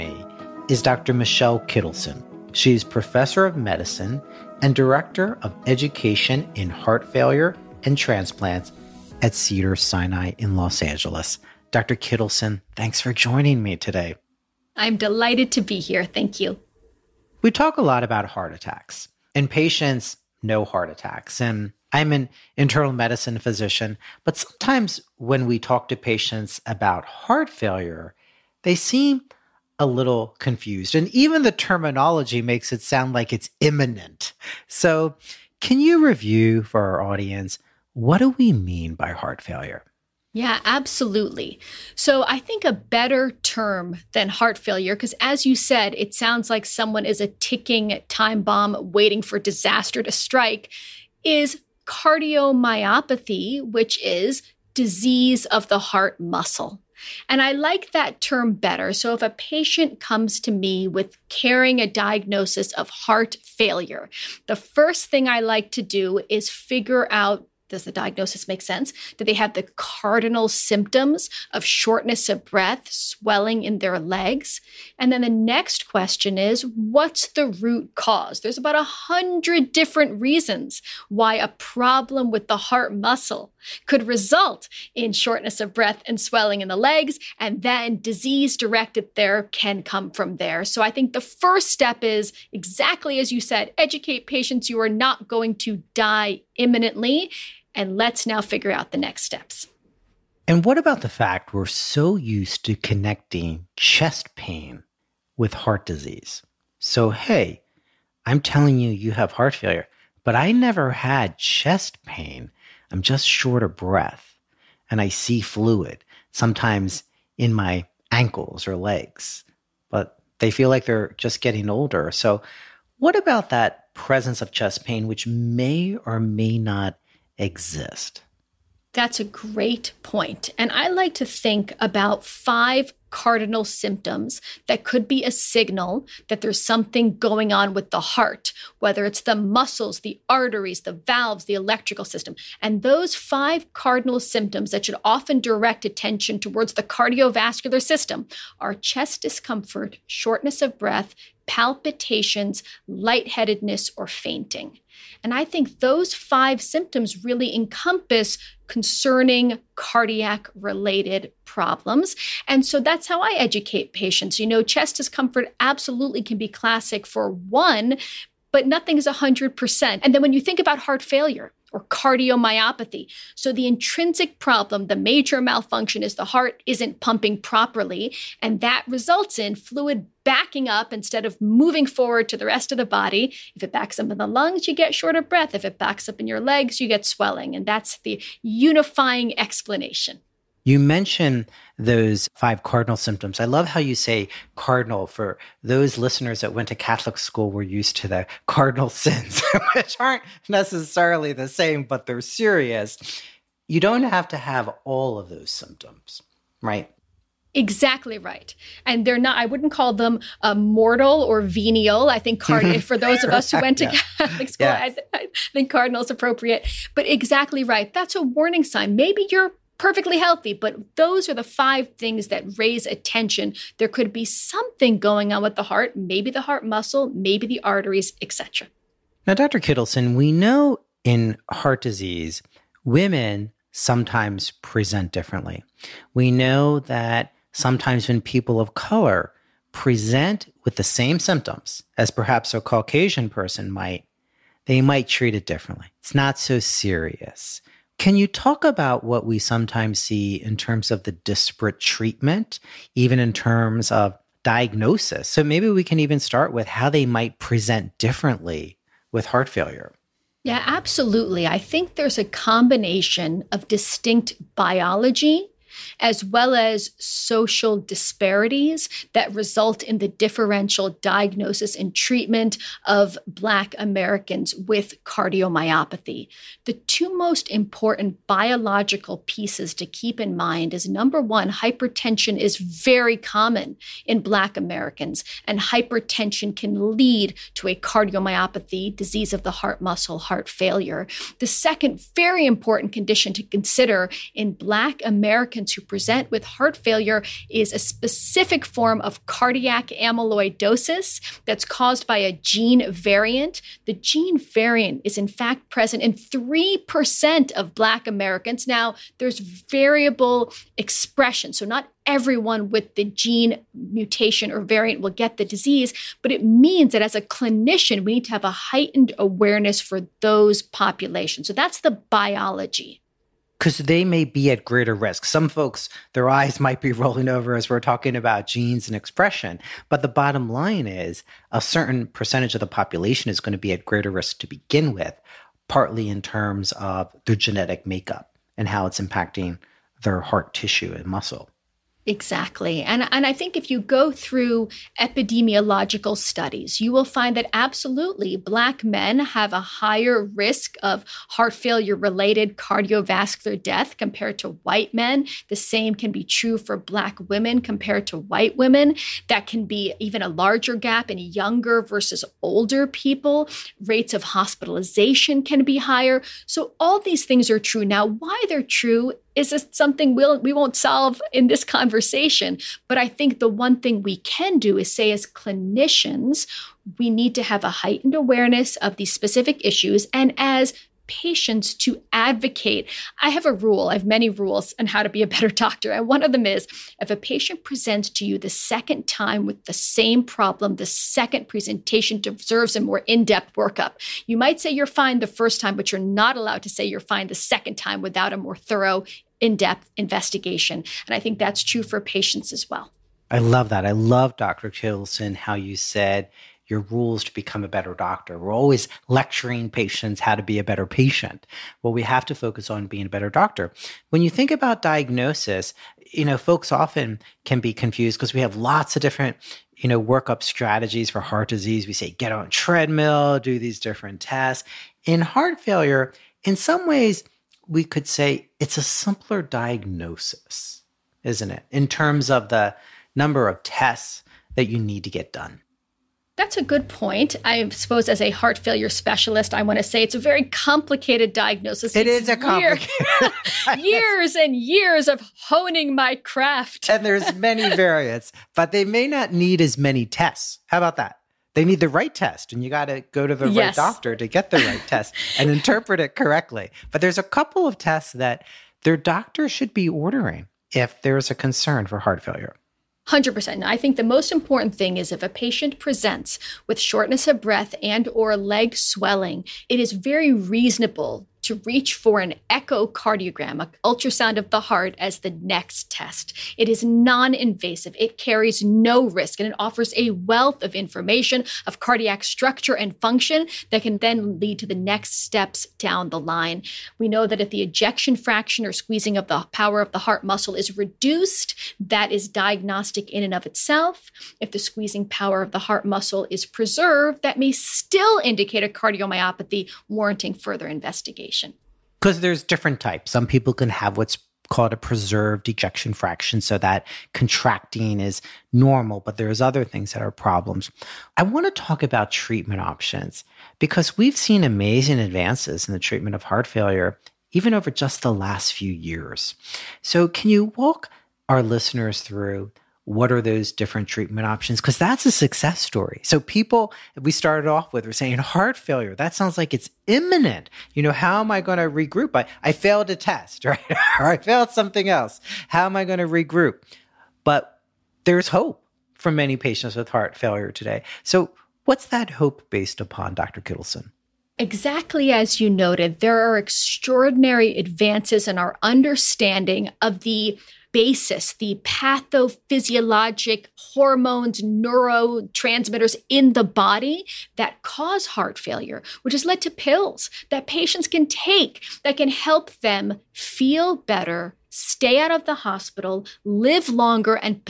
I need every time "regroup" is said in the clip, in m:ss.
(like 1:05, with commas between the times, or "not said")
8:51, 8:56.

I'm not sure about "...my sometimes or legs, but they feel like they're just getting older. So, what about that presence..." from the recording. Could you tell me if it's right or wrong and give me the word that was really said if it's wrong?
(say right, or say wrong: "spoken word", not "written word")
wrong: "ankles", not "sometimes".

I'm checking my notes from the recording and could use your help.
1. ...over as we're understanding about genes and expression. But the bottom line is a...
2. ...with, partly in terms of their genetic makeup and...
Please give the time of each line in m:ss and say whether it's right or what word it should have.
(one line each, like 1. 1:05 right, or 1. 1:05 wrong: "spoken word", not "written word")
1. 5:27 wrong: "talking", not "understanding"
2. 5:34 right.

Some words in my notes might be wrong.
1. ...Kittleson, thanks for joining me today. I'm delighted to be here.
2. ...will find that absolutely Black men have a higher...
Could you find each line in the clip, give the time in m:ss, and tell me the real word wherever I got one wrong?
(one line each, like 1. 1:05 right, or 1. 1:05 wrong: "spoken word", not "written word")
1. 0:11 right
2. 5:46 right.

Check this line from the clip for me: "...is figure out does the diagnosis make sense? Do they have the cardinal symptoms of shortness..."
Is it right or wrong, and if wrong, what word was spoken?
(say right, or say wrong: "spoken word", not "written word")
right.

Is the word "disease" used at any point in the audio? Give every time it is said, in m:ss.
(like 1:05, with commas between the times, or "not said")
0:54, 1:27, 1:45, 3:51, 4:48, 5:15, 7:01.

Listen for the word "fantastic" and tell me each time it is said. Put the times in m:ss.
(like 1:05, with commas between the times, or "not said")
not said.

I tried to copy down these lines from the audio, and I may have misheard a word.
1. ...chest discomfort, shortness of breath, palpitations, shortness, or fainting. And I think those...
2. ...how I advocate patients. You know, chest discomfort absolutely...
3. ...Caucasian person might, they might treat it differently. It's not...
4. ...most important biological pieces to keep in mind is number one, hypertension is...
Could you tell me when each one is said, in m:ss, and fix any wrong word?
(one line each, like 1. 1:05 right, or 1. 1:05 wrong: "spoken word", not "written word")
1. 2:28 wrong: "lightheadedness", not "shortness"
2. 2:43 wrong: "educate", not "advocate"
3. 4:02 right
4. 4:37 right.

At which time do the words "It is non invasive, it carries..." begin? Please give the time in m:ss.
7:56.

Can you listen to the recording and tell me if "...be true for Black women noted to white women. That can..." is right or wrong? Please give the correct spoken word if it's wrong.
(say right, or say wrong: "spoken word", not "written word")
wrong: "compared", not "noted".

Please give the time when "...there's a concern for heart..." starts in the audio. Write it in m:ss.
7:41.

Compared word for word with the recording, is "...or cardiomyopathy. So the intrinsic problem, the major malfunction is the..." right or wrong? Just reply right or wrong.
right.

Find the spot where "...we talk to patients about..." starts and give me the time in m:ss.
0:25.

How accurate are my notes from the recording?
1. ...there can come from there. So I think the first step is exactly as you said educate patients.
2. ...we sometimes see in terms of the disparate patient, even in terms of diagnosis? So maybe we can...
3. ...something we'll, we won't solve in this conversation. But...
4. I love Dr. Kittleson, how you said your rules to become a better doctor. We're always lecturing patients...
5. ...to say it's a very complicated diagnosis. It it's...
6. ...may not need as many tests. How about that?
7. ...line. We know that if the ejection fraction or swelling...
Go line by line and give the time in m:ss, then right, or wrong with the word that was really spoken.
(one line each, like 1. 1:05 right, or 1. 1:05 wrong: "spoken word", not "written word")
1. 1:29 right
2. 4:09 wrong: "treatment", not "patient"
3. 6:09 right
4. 6:43 right
5. 7:19 right
6. 7:28 right
7. 8:06 wrong: "squeezing", not "swelling".